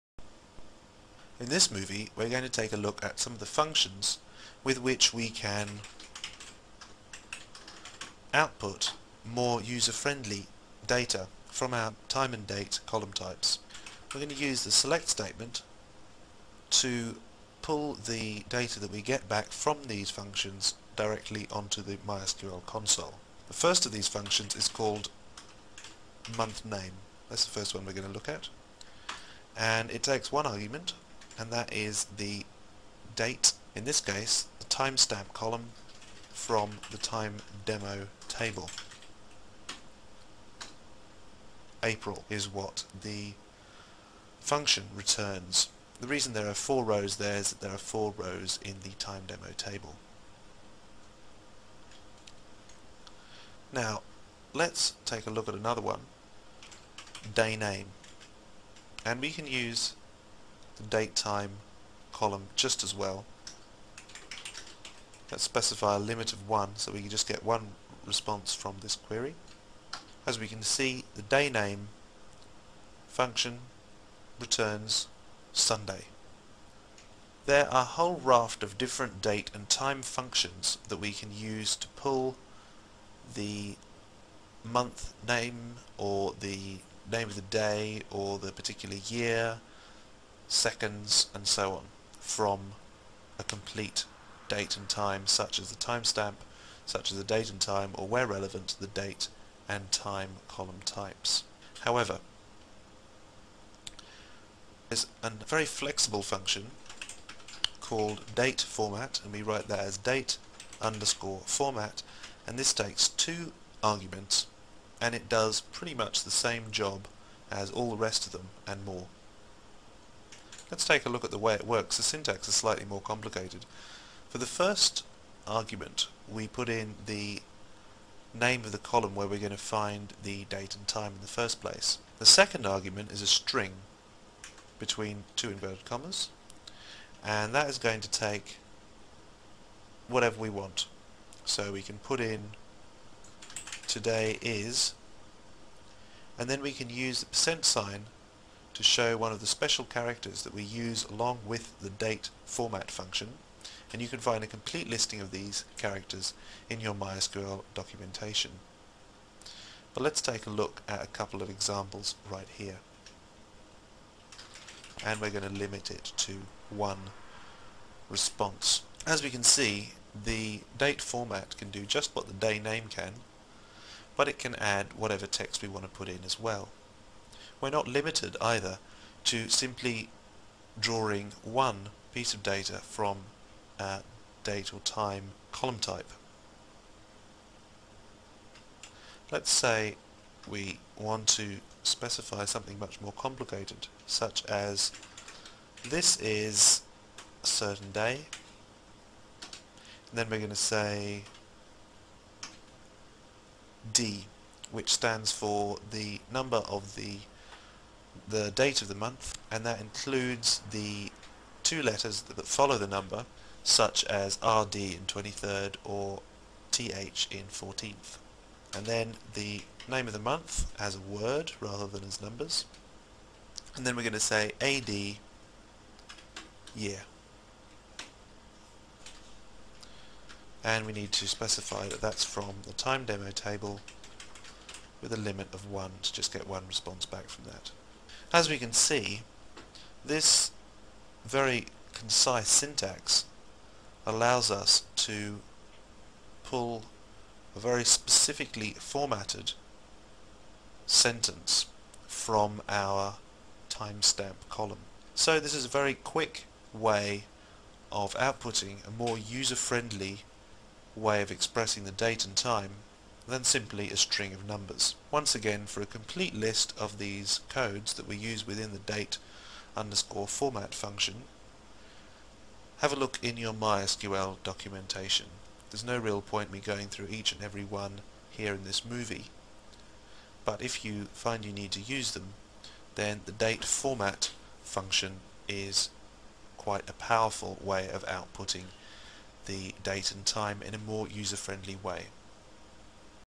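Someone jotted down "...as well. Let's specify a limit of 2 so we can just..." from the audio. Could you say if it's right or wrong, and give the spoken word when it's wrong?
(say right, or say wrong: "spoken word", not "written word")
wrong: "1", not "2".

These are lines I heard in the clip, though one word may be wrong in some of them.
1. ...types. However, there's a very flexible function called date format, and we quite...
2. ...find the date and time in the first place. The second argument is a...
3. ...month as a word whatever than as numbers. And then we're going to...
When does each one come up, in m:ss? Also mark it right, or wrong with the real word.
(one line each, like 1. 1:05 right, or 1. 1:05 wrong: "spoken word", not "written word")
1. 1:40 wrong: "write", not "quite"
2. 2:09 right
3. 3:40 wrong: "rather", not "whatever".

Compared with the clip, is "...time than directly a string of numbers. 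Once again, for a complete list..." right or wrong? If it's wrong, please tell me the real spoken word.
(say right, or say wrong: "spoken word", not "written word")
wrong: "simply", not "directly".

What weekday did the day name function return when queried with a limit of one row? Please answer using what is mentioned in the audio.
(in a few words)
Sunday.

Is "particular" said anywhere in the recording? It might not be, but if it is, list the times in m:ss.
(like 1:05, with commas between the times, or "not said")
1:28.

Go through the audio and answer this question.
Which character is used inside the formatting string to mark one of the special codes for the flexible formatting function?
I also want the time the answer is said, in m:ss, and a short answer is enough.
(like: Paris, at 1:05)
percent sign, at 2:27.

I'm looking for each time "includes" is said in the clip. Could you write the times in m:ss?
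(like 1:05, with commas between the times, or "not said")
3:29.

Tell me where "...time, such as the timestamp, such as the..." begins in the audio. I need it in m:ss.
1:34.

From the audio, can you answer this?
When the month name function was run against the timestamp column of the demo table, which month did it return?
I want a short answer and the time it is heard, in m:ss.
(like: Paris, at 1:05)
April, at 0:41.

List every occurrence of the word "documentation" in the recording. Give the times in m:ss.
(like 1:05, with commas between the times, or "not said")
2:37, 4:34.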